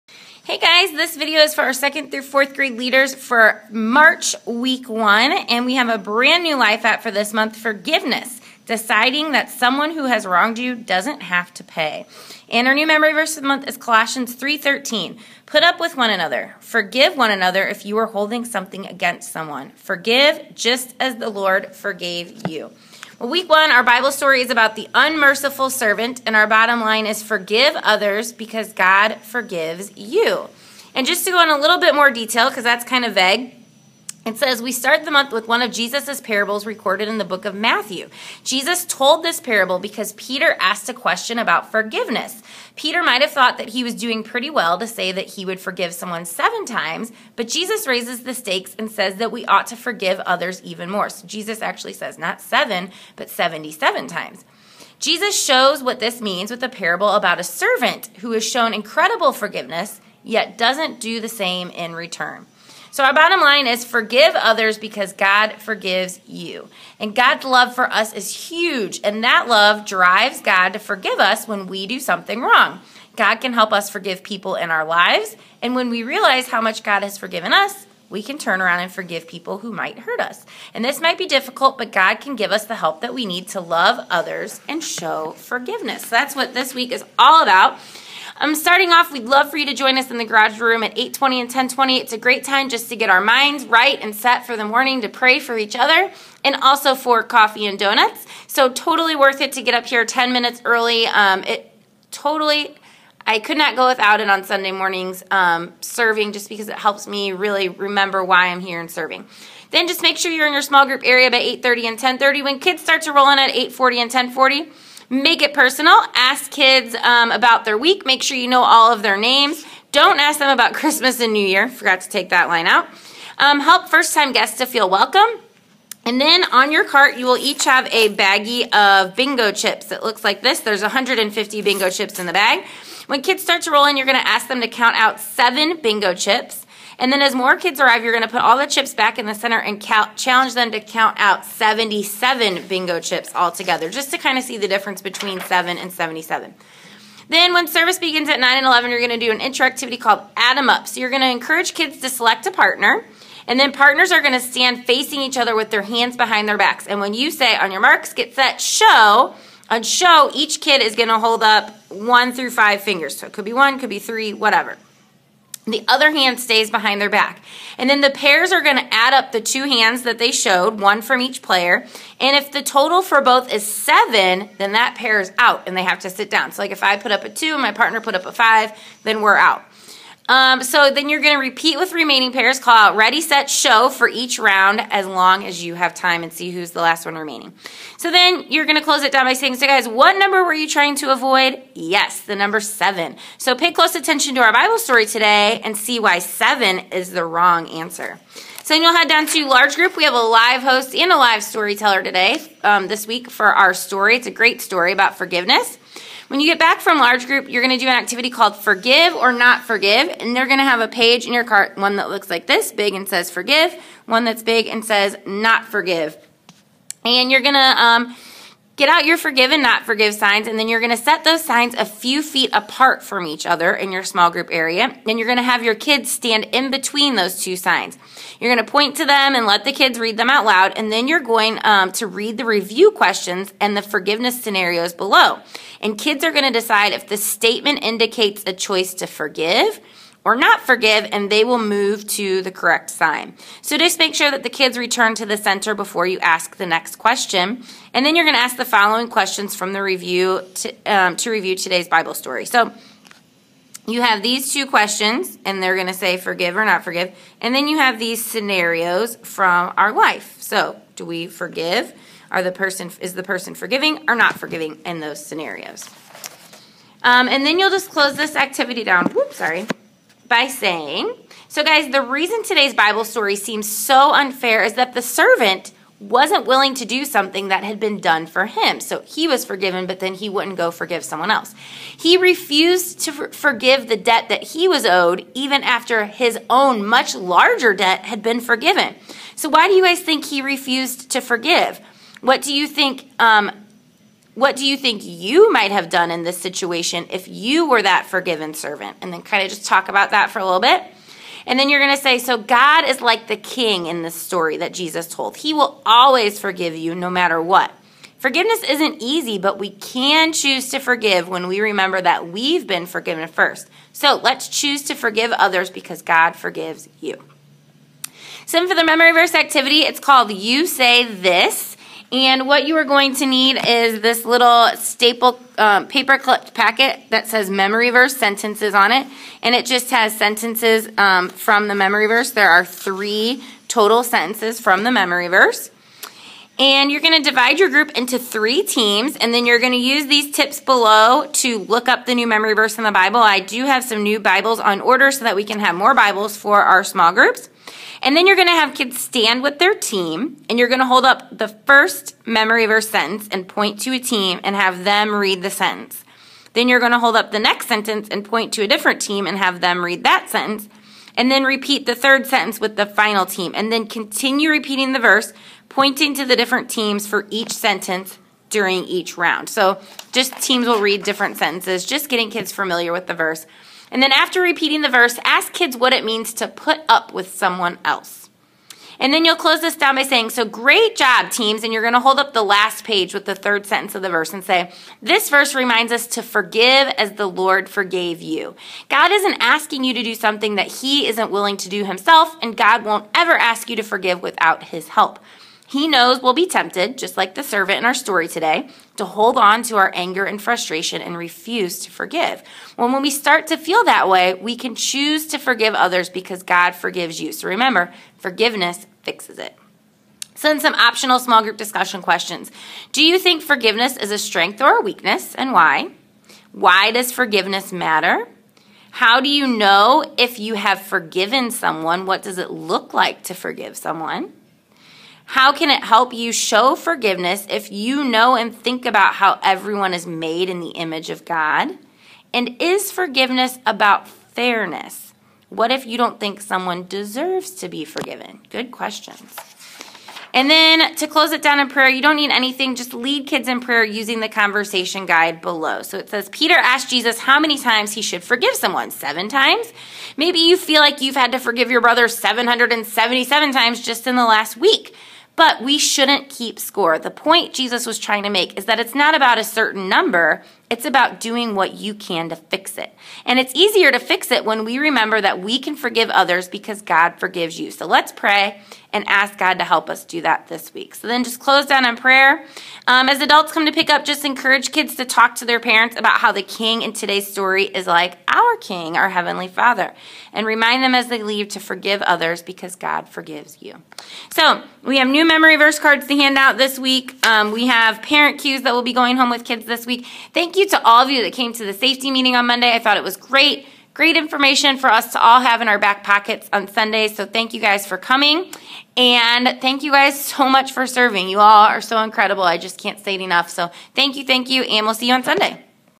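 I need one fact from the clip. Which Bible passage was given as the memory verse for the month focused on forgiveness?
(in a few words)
Colossians 3:13.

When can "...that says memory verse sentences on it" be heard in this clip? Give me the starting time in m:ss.
5:27.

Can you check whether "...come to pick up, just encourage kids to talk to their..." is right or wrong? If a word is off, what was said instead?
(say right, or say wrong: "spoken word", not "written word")
right.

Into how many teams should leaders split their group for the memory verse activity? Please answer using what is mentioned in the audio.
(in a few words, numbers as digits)
3.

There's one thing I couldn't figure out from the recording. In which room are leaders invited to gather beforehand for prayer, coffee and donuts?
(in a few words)
garage room.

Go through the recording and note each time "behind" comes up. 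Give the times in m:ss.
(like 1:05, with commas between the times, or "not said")
2:36, 2:46.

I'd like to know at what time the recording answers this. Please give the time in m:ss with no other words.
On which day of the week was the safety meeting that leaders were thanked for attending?
8:12.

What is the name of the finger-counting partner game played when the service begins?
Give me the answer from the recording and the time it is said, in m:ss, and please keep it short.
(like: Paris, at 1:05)
Add 'em Up, at 2:30.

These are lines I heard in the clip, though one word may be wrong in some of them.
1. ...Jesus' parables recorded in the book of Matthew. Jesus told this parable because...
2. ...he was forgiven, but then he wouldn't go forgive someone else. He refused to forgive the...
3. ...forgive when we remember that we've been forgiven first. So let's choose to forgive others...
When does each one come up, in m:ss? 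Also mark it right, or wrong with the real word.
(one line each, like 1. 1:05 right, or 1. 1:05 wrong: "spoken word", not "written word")
1. 0:35 right
2. 4:39 right
3. 5:10 right.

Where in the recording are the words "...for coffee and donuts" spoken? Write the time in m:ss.
1:36.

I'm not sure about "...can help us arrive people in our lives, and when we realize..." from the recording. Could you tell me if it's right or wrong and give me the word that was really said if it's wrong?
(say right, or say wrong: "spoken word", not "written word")
wrong: "forgive", not "arrive".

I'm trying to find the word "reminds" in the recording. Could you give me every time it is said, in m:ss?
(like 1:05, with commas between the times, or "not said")
6:25, 8:00.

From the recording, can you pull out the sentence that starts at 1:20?
And this might be difficult, but God can give us the help that we need to love others and show forgiveness.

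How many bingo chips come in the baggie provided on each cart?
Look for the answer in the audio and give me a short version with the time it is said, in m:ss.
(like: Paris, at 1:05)
150, at 2:10.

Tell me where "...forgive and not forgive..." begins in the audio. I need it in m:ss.
3:39.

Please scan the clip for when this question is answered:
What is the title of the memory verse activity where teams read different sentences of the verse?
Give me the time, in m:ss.
5:20.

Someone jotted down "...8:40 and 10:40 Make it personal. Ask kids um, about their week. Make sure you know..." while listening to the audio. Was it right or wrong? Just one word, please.
right.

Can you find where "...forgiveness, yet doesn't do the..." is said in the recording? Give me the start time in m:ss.
0:59.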